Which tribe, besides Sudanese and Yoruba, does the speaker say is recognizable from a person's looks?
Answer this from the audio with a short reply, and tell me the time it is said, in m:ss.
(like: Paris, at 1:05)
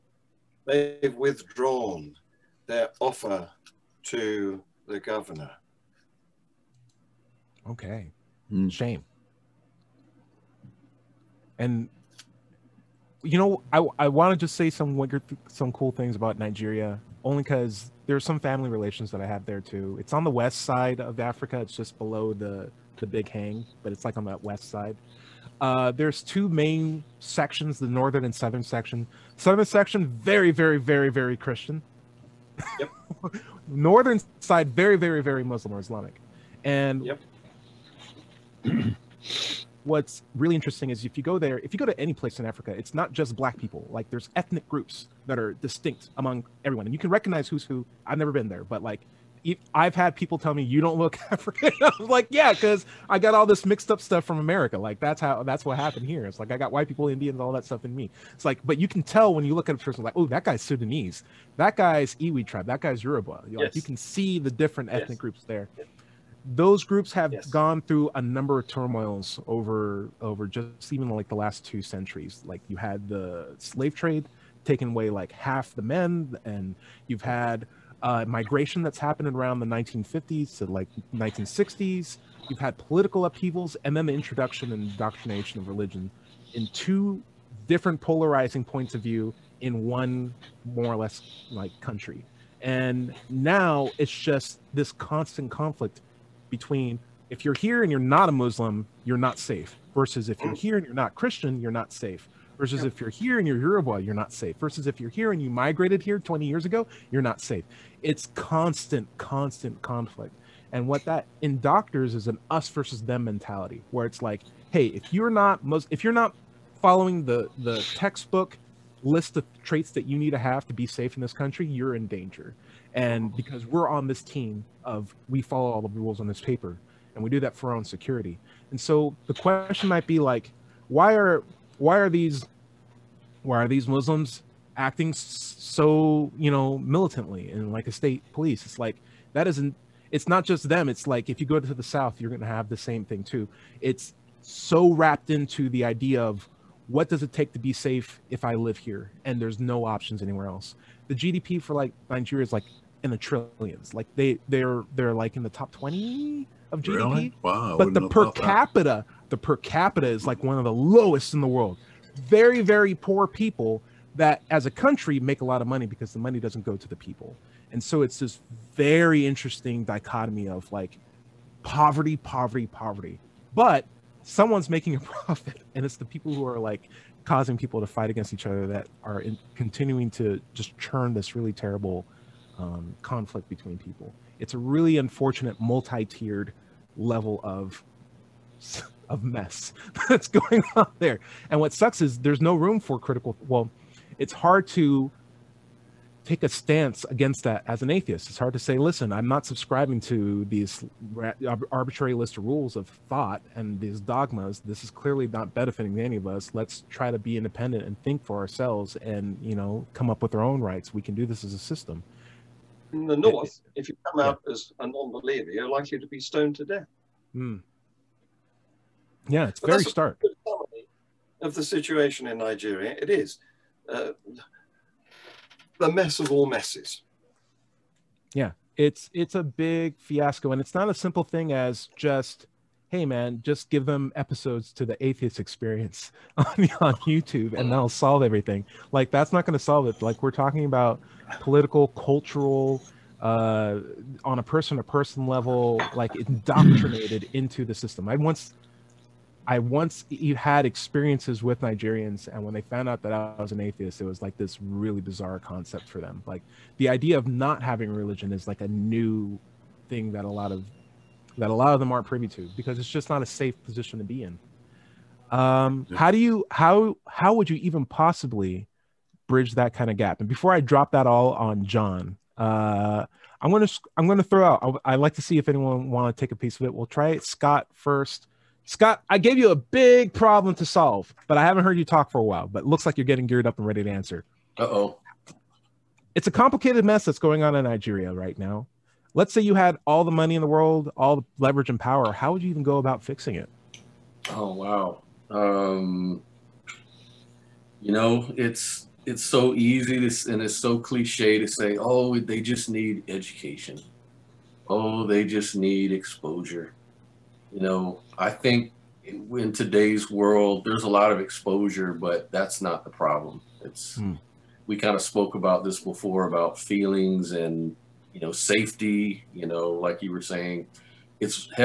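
Iwi, at 1:02.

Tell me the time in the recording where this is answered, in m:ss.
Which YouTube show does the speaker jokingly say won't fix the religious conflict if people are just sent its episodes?
3:54.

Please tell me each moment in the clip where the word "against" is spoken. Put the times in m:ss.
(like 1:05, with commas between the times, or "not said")
2:58, 3:17.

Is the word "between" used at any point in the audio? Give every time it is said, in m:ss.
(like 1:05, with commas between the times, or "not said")
1:36, 3:03.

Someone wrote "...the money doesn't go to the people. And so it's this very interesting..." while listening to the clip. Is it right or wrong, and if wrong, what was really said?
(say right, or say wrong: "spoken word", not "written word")
right.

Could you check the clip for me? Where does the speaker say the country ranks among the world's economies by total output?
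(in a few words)
top twenty.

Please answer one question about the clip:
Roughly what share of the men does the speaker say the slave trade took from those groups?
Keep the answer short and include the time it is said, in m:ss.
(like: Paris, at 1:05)
half, at 1:15.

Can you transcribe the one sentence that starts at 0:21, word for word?
It's just below the the Big Hang, but it's like on that west side.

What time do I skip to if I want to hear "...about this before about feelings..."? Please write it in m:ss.
5:15.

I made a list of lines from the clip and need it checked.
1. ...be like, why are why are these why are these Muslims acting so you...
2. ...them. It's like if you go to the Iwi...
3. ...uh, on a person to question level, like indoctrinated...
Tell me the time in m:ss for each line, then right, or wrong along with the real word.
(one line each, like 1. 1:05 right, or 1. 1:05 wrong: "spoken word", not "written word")
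1. 2:10 right
2. 2:20 wrong: "South", not "Iwi"
3. 4:03 wrong: "person", not "question".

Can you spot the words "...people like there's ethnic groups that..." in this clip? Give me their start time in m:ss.
0:43.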